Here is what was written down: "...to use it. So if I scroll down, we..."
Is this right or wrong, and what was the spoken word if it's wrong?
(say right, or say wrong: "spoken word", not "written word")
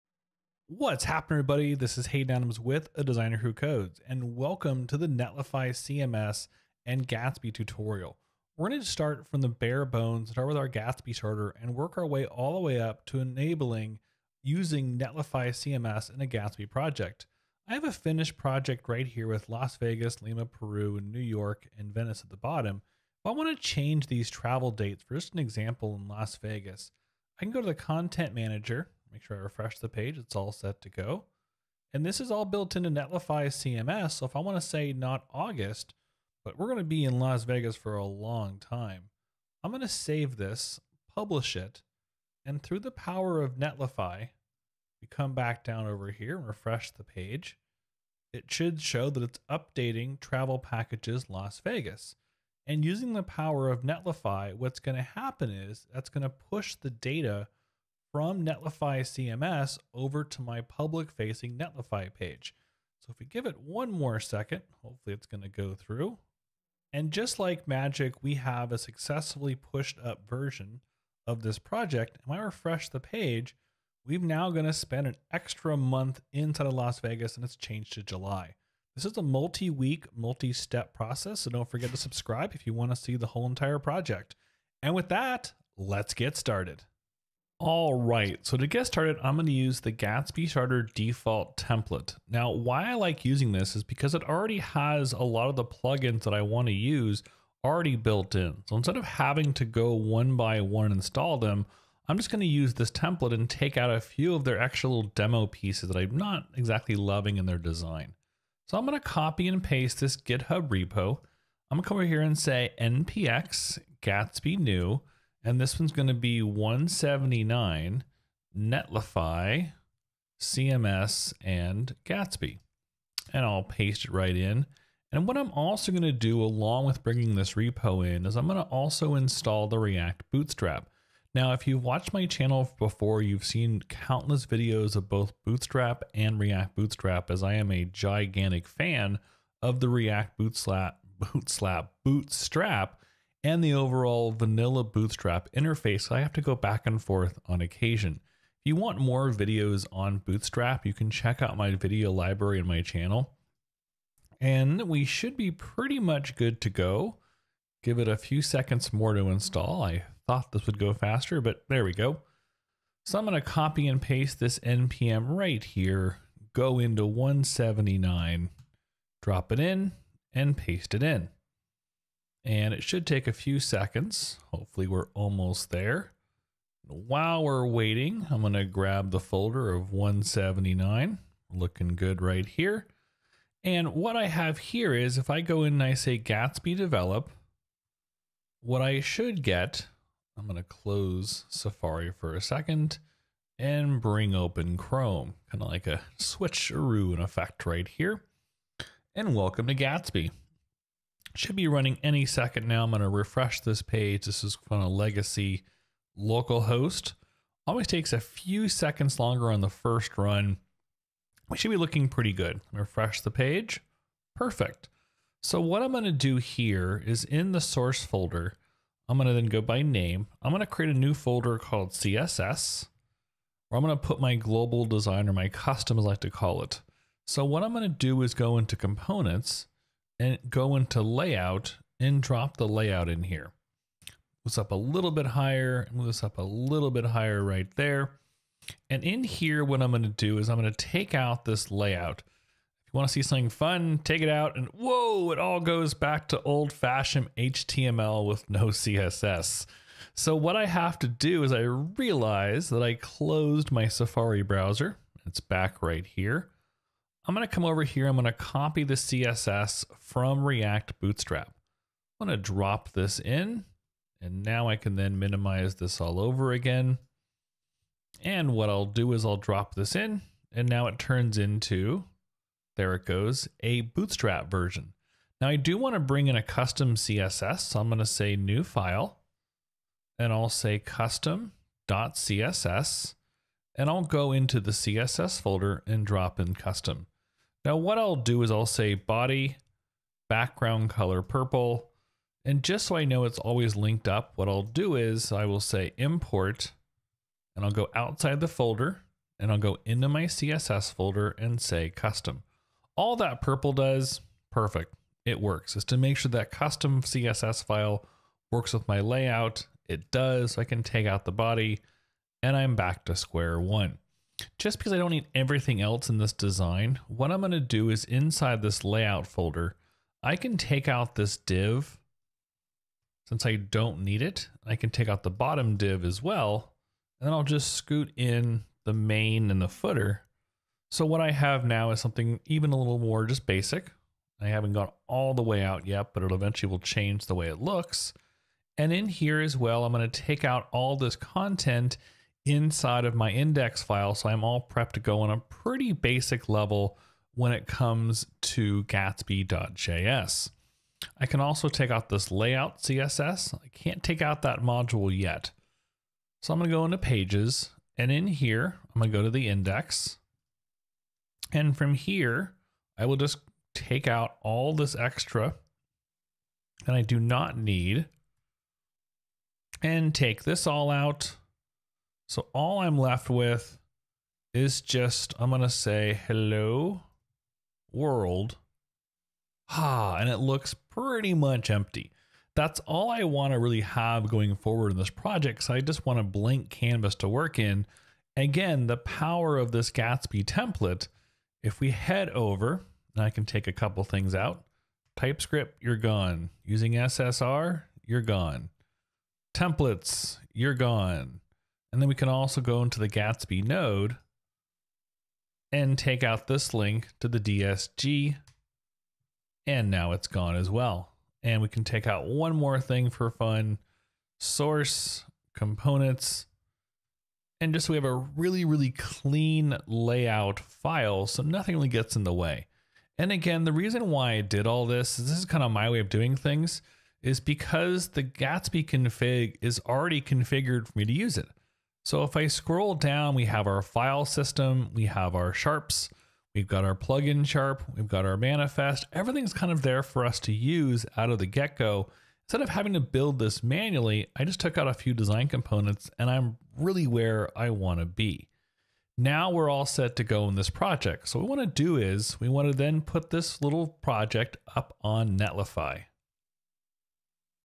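right.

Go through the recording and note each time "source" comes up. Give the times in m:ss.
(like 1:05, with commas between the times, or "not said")
3:37, 6:54.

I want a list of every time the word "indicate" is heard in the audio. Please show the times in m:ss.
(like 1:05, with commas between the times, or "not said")
not said.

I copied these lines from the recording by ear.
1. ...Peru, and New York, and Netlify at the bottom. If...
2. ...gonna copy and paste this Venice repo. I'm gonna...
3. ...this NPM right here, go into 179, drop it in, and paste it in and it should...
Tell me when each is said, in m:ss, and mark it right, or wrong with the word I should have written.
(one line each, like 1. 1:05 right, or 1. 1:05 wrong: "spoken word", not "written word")
1. 0:20 wrong: "Venice", not "Netlify"
2. 1:48 wrong: "GitHub", not "Venice"
3. 2:44 right.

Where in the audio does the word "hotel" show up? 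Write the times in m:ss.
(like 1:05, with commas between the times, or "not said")
not said.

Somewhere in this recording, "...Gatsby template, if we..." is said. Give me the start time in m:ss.
6:29.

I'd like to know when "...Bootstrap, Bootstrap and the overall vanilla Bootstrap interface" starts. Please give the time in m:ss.
2:21.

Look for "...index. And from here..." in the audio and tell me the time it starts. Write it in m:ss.
5:59.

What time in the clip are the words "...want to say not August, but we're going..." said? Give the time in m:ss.
0:34.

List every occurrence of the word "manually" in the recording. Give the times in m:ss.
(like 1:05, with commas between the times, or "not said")
7:23.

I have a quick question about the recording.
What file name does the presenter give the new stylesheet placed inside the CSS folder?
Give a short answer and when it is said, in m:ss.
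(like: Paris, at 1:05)
custom.css, at 4:40.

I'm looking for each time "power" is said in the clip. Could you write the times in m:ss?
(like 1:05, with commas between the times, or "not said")
0:42, 0:53, 6:28.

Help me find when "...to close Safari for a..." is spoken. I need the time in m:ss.
3:10.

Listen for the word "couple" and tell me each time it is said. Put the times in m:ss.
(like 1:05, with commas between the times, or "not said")
6:33.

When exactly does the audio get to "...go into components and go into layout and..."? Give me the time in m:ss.
3:48.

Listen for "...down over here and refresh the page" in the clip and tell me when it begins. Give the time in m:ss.
0:45.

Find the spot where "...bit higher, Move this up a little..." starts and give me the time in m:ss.
3:55.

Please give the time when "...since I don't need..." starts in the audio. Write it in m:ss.
5:23.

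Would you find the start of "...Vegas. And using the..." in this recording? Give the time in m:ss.
0:51.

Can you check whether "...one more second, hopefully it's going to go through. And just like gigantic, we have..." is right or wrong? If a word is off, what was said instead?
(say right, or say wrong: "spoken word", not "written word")
wrong: "magic", not "gigantic".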